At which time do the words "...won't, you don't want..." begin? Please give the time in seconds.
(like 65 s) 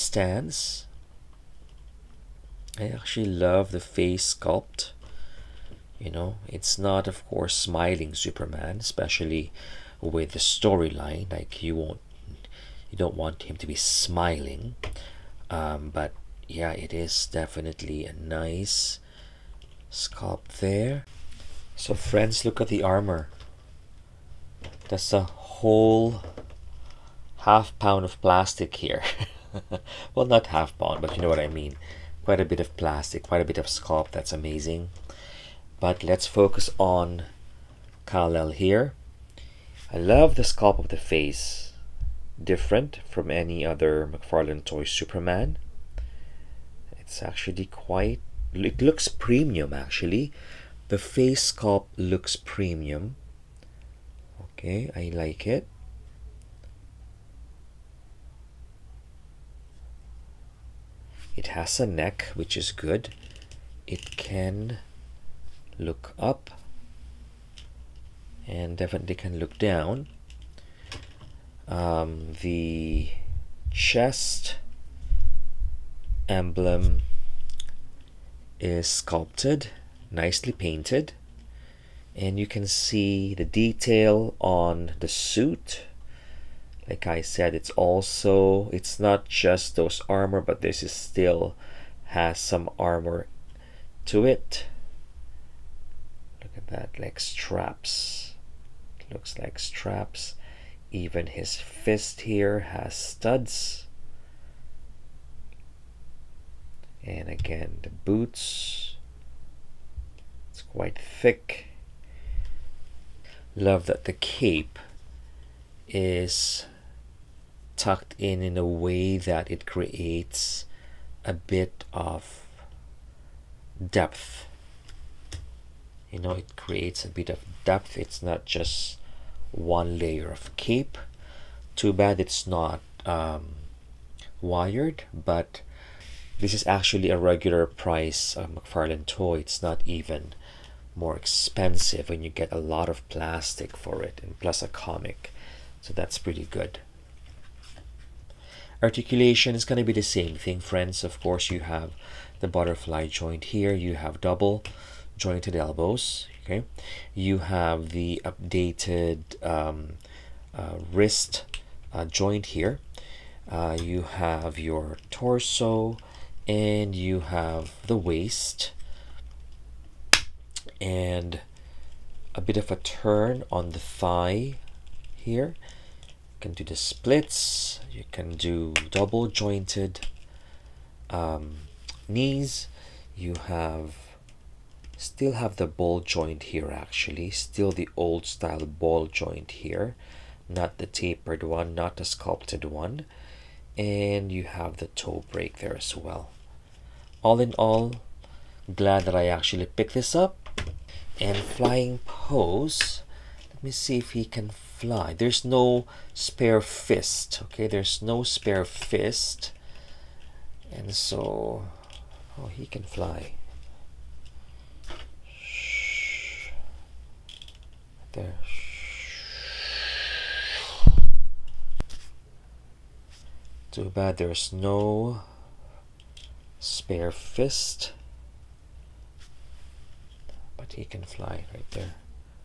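11 s.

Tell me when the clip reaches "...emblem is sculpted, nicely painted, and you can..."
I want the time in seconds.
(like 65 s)
76 s.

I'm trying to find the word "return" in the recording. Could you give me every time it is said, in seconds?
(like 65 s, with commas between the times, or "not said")
not said.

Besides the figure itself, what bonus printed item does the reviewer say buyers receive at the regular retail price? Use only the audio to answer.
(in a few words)
a comic.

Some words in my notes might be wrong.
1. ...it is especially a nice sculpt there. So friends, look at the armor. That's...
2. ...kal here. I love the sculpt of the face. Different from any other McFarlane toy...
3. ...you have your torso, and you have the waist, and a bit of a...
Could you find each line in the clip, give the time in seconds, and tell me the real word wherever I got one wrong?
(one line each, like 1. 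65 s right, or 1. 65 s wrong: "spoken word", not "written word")
1. 16 s wrong: "definitely", not "especially"
2. 38 s right
3. 163 s right.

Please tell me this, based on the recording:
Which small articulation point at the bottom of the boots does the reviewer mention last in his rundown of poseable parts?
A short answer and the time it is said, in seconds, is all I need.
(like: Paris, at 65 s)
toe break, at 194 s.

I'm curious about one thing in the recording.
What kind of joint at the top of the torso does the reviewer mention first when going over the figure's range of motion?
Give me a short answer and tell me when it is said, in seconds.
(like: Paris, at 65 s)
butterfly joint, at 152 s.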